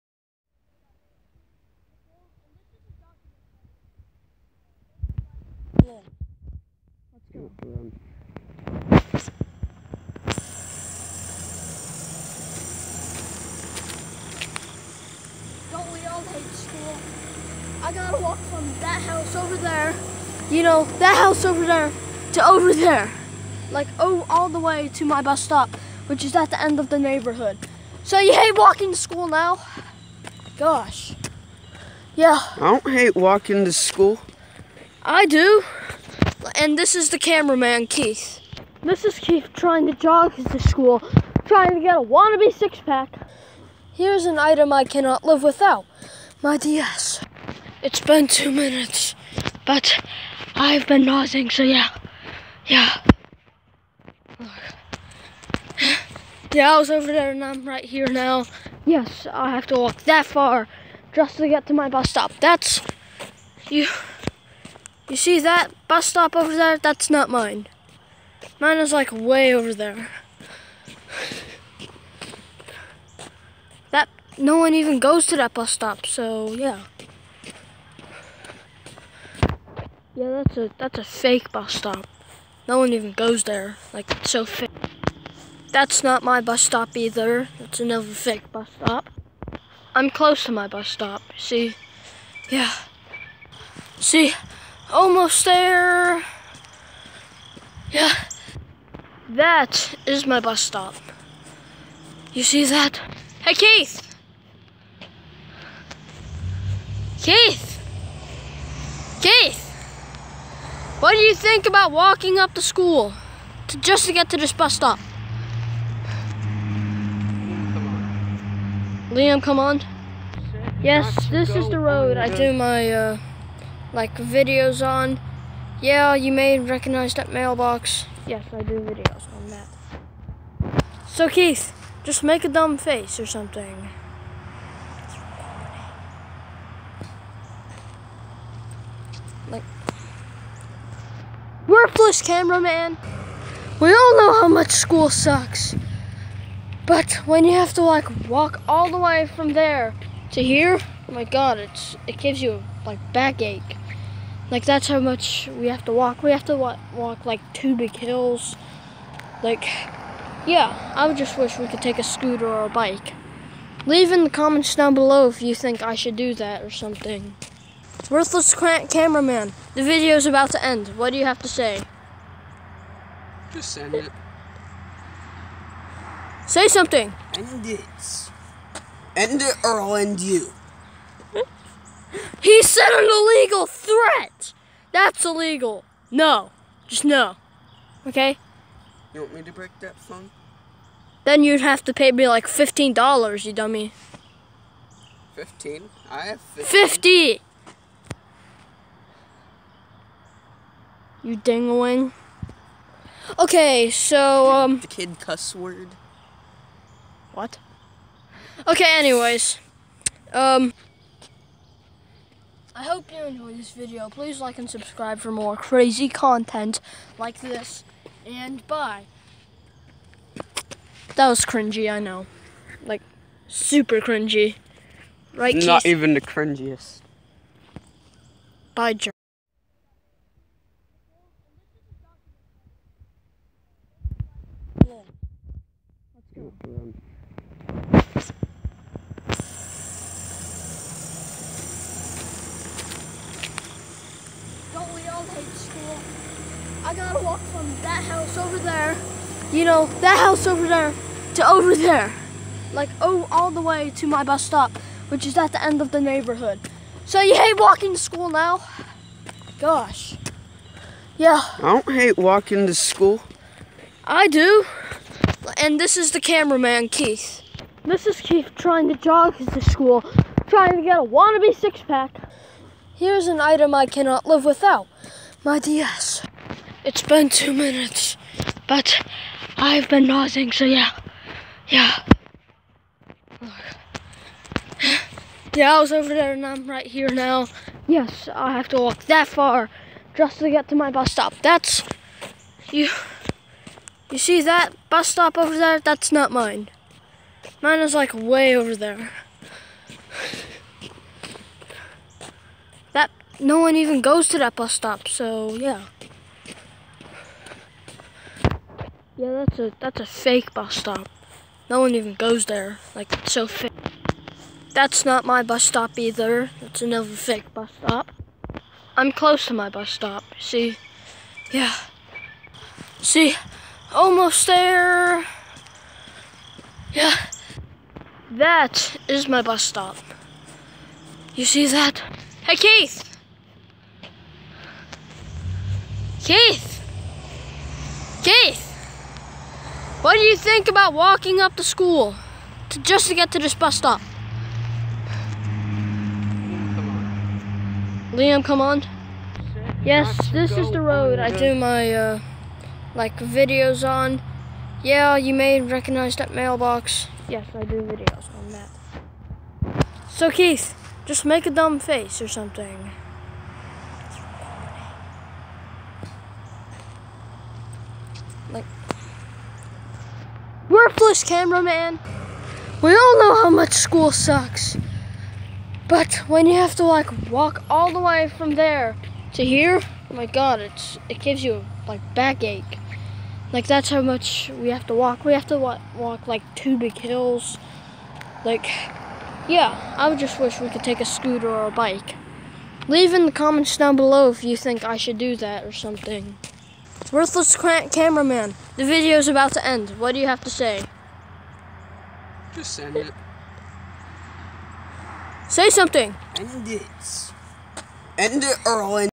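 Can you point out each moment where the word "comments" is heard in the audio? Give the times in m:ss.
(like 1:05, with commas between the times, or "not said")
2:44, 6:33.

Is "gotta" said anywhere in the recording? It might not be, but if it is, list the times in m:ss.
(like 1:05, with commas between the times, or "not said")
0:17, 4:06.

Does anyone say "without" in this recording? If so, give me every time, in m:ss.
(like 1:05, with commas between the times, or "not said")
0:45, 4:34.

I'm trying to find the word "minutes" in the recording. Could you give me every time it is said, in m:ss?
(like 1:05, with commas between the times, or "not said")
0:48, 4:37.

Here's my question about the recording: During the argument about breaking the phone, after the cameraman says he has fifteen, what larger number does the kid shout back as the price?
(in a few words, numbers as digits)
50.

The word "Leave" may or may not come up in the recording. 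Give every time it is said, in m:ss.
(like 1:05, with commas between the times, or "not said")
2:43, 6:32.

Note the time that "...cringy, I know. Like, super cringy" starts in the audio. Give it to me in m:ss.
3:41.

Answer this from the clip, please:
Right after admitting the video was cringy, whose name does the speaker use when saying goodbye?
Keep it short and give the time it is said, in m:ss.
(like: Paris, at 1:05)
John, at 3:48.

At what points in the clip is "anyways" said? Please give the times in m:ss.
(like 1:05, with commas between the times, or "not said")
3:28.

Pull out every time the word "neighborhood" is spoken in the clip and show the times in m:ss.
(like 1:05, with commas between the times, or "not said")
0:26, 4:15.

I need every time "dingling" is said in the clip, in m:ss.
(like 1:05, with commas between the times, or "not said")
3:21.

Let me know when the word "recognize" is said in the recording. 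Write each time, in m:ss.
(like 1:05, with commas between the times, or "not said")
2:06, 5:55.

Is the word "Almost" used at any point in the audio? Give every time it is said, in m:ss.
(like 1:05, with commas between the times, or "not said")
1:34, 5:23.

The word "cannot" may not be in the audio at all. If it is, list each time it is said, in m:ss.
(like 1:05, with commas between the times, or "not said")
0:44, 4:33.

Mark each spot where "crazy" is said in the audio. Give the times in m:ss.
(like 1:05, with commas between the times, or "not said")
3:35.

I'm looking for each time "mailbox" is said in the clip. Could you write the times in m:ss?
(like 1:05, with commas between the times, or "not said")
2:07, 5:56.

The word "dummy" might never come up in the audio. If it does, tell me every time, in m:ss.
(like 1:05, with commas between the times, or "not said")
3:13.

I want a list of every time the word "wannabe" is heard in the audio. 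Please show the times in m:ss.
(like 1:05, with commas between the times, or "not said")
0:42, 4:31.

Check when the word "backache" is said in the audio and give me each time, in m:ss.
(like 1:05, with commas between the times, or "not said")
2:33, 6:22.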